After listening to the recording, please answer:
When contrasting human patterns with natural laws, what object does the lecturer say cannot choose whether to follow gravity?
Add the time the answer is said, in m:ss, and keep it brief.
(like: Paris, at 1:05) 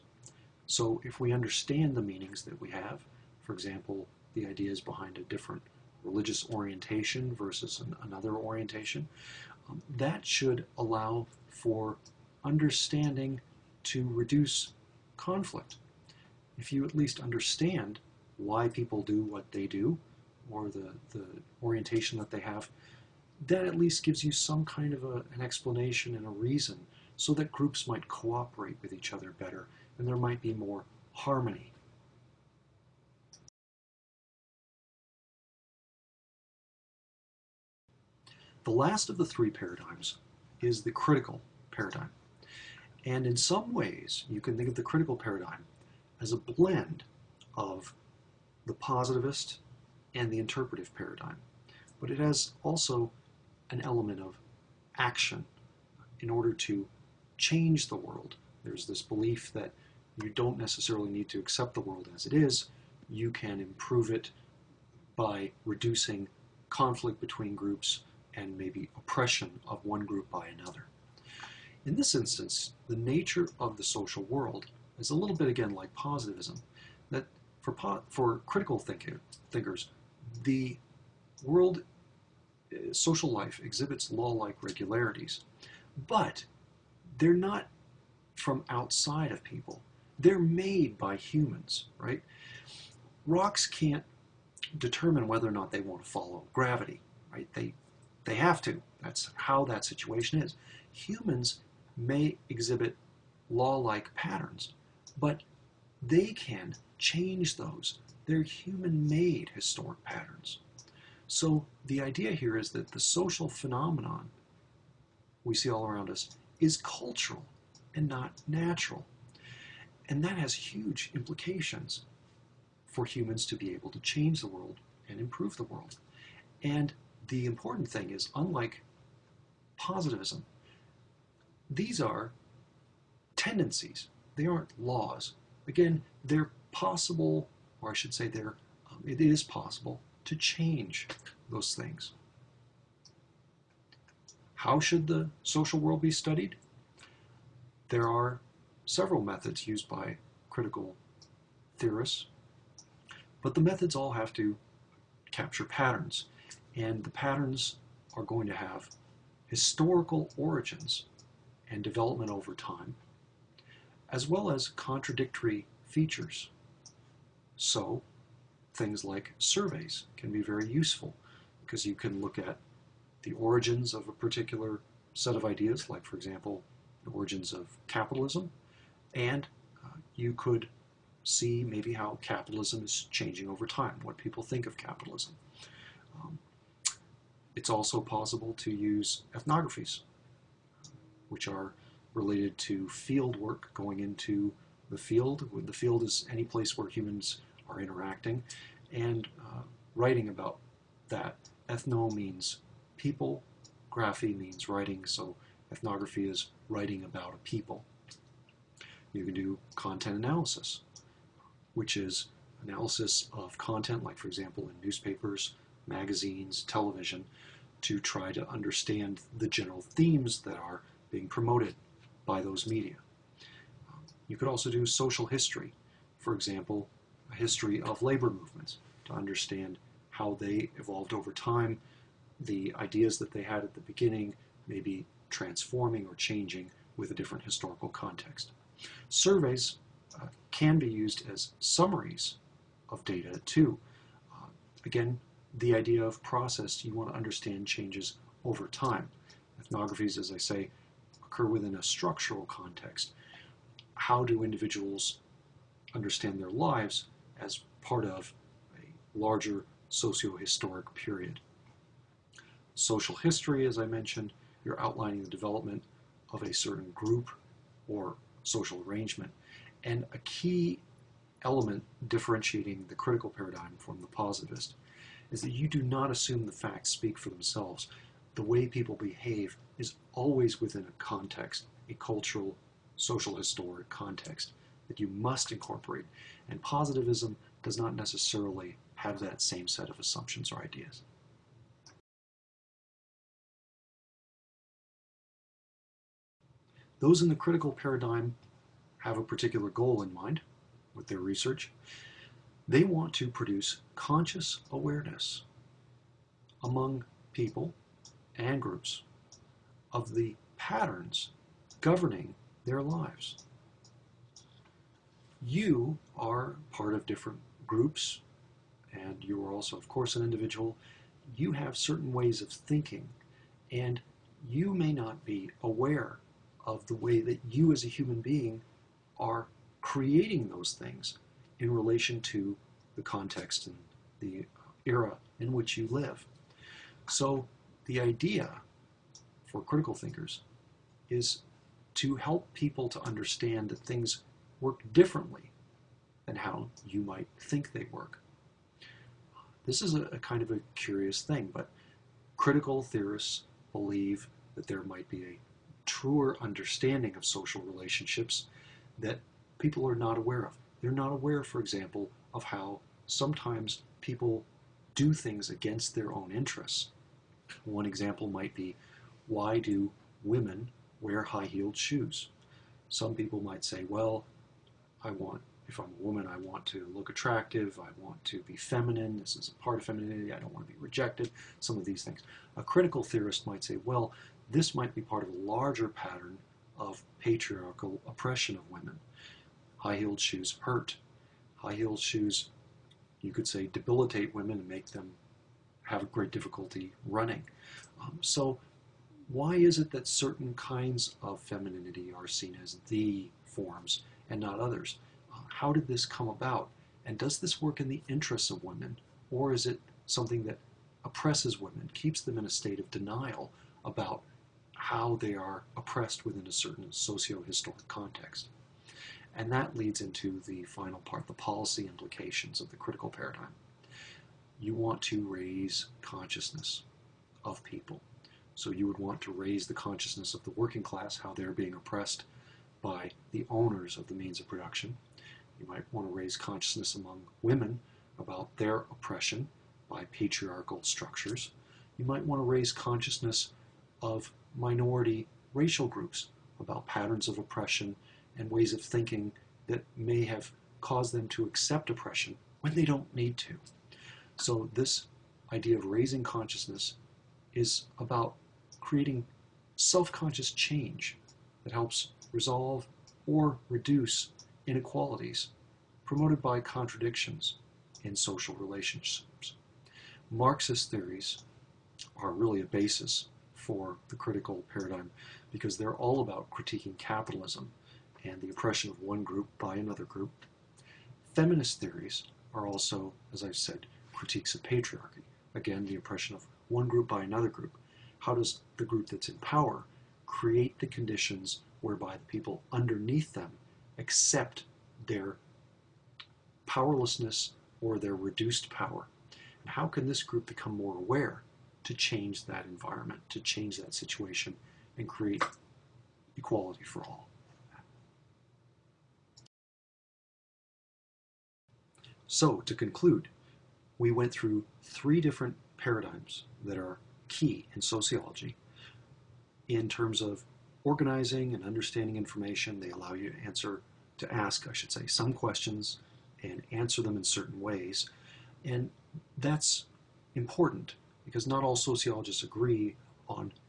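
Rocks, at 1:33.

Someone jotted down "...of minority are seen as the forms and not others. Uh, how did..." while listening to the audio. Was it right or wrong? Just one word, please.
wrong.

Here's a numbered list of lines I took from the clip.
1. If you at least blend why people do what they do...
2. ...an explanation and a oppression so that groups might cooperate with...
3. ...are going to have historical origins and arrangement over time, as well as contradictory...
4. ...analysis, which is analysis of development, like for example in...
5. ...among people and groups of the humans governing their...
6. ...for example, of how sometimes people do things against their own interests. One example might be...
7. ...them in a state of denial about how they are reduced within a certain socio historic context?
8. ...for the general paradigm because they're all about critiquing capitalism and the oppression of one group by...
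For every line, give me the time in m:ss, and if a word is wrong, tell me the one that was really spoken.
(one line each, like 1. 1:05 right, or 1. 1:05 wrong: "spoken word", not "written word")
1. 0:16 wrong: "understand", not "blend"
2. 0:25 wrong: "reason", not "oppression"
3. 2:38 wrong: "development", not "arrangement"
4. 3:30 wrong: "content", not "development"
5. 5:06 wrong: "patterns", not "humans"
6. 6:01 right
7. 6:52 wrong: "oppressed", not "reduced"
8. 7:53 wrong: "critical", not "general".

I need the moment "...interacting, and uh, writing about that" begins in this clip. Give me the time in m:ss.
3:17.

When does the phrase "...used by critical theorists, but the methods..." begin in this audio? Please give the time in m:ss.
2:29.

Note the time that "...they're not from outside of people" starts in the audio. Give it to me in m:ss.
1:27.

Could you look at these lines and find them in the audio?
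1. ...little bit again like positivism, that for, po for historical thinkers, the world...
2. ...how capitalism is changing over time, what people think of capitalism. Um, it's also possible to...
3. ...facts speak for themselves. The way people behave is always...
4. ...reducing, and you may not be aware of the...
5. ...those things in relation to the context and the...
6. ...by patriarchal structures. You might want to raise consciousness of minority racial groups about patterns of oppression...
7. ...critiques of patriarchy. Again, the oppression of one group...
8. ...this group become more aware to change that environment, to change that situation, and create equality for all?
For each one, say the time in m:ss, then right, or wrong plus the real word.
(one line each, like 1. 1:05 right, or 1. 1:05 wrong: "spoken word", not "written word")
1. 1:15 wrong: "critical", not "historical"
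2. 3:01 right
3. 4:36 right
4. 5:22 wrong: "thinking", not "reducing"
5. 5:30 right
6. 7:19 right
7. 8:04 right
8. 8:20 right.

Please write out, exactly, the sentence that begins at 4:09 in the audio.
Ethnographies, as I say, occur within a structural context.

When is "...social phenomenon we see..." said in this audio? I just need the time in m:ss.
1:53.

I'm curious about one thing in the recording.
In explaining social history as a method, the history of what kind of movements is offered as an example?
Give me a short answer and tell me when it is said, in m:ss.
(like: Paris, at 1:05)
Labor movements, at 3:48.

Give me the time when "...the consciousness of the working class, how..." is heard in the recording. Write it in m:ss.
7:09.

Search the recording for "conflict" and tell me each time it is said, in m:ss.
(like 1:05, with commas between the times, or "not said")
0:15, 1:06.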